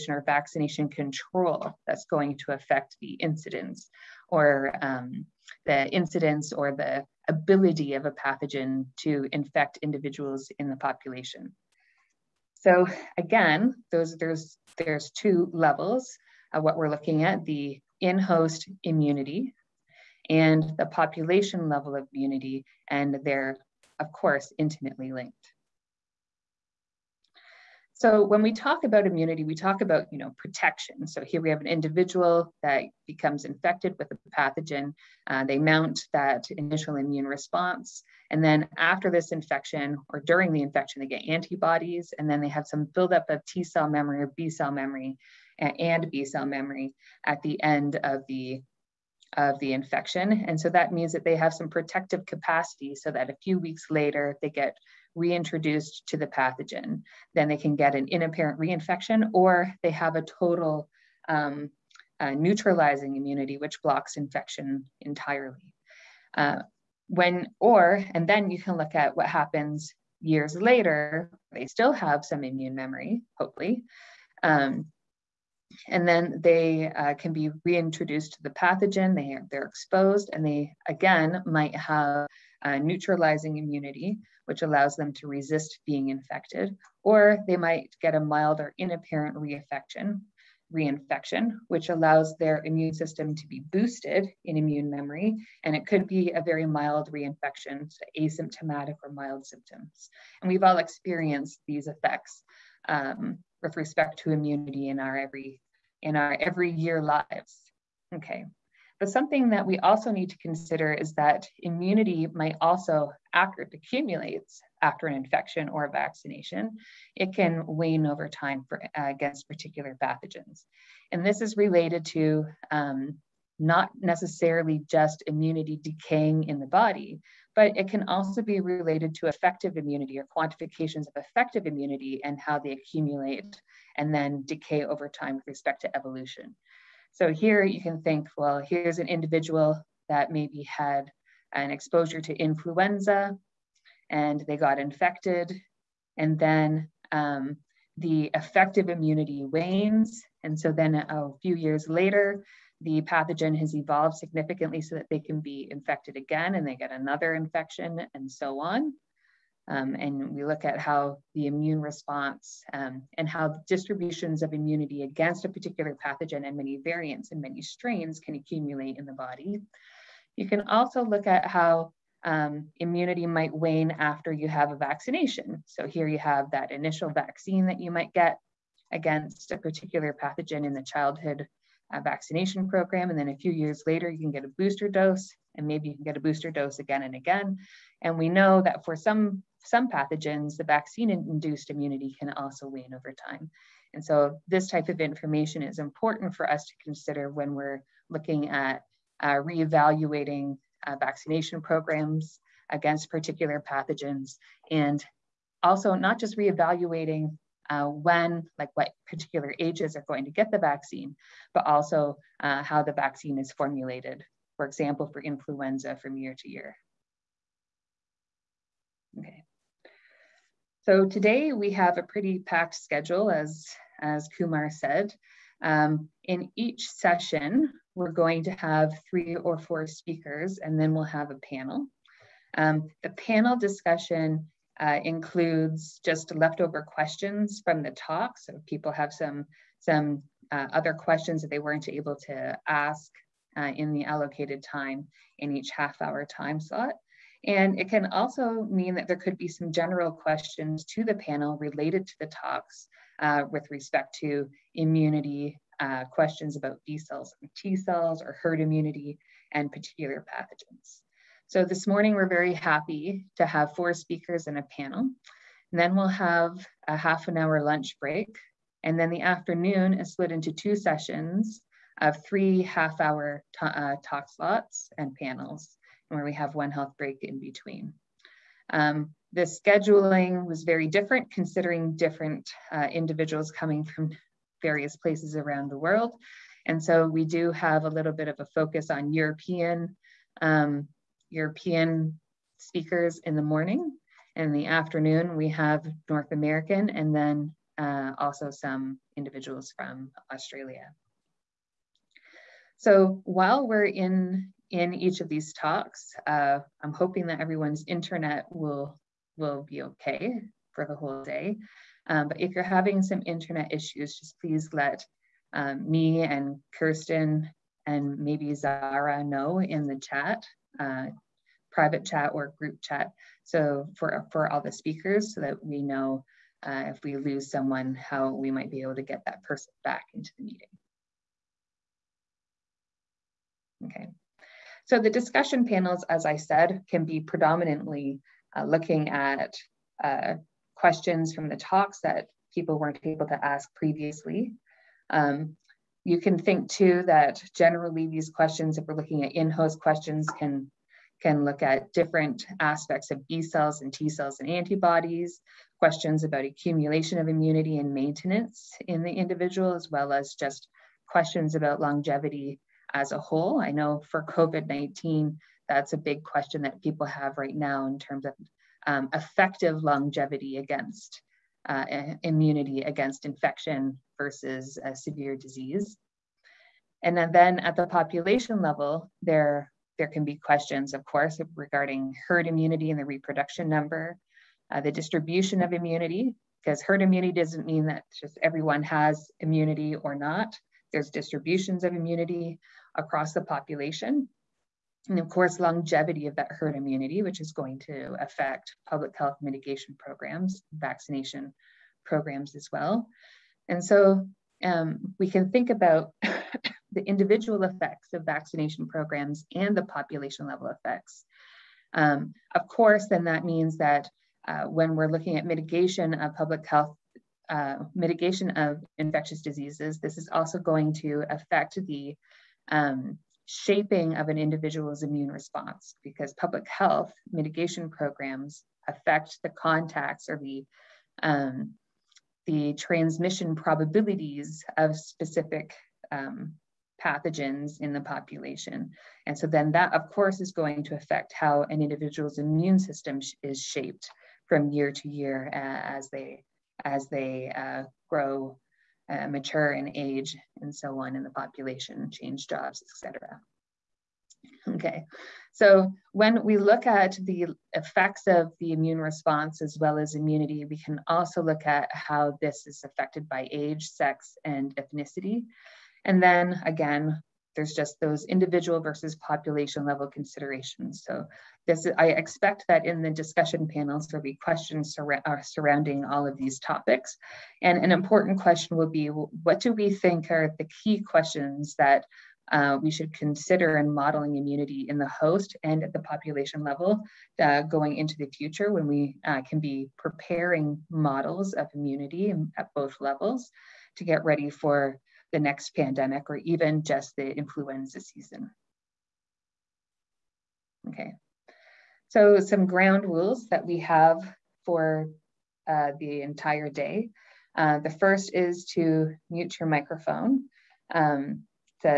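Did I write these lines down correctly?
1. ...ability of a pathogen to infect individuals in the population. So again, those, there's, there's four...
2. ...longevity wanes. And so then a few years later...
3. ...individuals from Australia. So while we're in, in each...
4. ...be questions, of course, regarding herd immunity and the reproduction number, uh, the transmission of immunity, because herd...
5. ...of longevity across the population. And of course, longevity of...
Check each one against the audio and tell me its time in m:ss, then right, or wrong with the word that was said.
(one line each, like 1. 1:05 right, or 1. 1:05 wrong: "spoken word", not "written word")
1. 0:07 wrong: "two", not "four"
2. 2:28 wrong: "immunity", not "longevity"
3. 4:59 right
4. 6:20 wrong: "distribution", not "transmission"
5. 6:31 wrong: "immunity", not "longevity".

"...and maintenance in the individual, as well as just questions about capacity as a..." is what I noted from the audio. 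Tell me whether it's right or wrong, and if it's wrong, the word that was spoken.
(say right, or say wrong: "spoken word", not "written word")
wrong: "longevity", not "capacity".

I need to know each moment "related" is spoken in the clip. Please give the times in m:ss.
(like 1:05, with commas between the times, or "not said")
2:01, 2:08, 4:11.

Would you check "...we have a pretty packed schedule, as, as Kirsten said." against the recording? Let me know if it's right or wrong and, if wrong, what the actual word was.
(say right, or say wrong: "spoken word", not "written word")
wrong: "Kumar", not "Kirsten".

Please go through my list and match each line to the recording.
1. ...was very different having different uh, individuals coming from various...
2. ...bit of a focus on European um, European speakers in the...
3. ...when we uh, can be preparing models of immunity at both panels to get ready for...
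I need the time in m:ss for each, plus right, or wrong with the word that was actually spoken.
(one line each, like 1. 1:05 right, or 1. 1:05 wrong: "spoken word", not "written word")
1. 4:40 wrong: "considering", not "having"
2. 4:48 right
3. 8:08 wrong: "levels", not "panels".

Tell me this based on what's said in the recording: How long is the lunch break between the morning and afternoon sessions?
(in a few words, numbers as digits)
Half an hour.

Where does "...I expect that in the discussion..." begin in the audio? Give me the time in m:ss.
7:51.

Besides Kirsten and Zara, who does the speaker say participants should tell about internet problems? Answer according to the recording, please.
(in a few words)
me.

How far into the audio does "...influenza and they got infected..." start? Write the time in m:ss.
2:22.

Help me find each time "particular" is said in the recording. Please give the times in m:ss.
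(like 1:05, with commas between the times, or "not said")
1:59, 2:45, 2:59, 3:23, 3:29, 4:19.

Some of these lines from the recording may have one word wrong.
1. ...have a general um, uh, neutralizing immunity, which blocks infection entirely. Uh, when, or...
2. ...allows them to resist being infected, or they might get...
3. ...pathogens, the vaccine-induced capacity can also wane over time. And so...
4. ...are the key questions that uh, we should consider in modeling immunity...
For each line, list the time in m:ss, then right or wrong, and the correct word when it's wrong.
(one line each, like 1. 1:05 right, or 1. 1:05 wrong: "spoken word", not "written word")
1. 0:59 wrong: "total", not "general"
2. 1:24 right
3. 3:09 wrong: "immunity", not "capacity"
4. 8:00 right.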